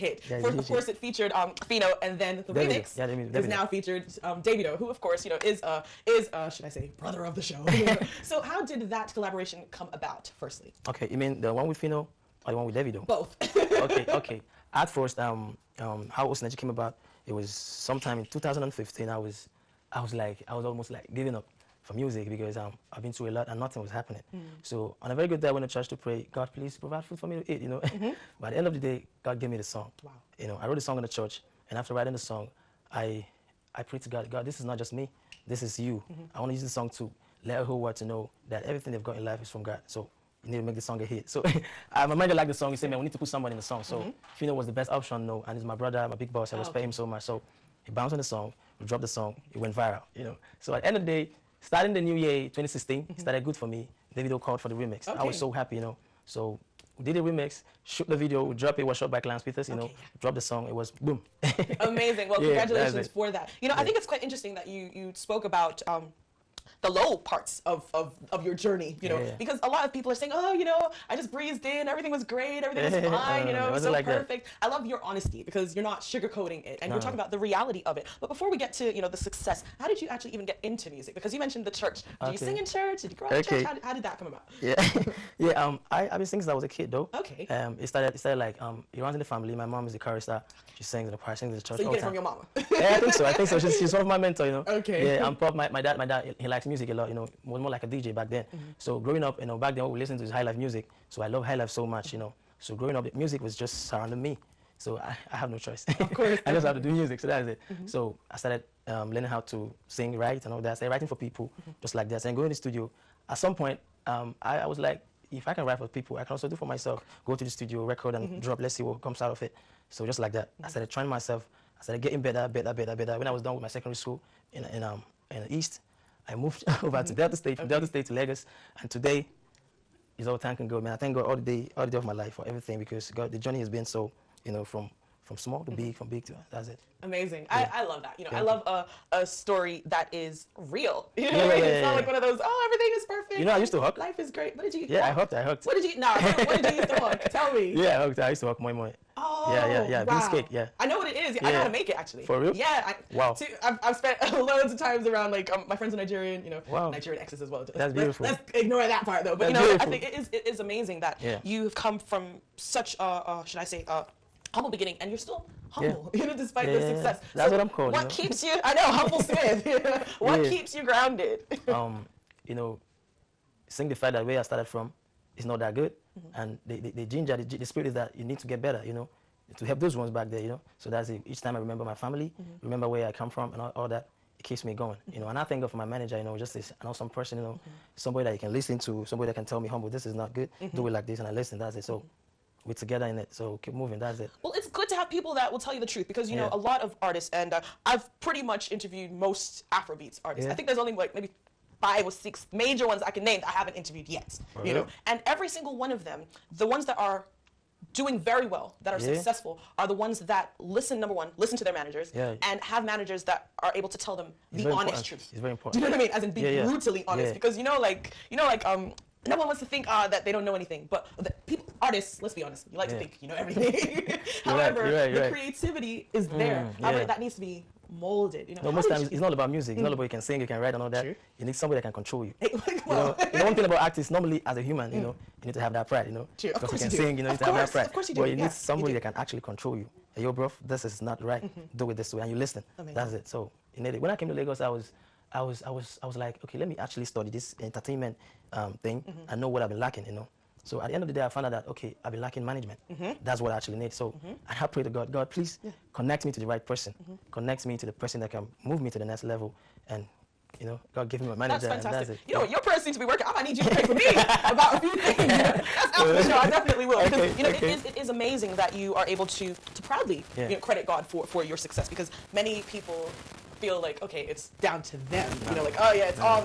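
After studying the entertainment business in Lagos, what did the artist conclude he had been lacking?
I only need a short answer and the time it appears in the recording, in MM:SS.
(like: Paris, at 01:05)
management, at 04:12.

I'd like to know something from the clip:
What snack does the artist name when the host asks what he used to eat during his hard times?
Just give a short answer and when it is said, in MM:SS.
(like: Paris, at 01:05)
Beans cake, at 02:30.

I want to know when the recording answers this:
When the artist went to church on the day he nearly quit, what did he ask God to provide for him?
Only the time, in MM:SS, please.
00:27.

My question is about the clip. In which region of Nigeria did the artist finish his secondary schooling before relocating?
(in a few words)
the East.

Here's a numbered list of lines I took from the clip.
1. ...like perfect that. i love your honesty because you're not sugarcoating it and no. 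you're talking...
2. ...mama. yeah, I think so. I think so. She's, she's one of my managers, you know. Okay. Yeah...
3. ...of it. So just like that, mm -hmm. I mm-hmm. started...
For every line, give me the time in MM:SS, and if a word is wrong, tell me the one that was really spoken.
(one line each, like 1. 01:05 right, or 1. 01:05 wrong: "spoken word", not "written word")
1. 01:13 right
2. 01:32 wrong: "mentors", not "managers"
3. 01:59 right.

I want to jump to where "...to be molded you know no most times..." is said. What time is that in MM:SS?
03:47.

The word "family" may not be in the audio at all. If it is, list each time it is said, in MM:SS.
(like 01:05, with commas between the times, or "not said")
01:29, 03:01.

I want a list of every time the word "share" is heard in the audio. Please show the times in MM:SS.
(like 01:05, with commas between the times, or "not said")
not said.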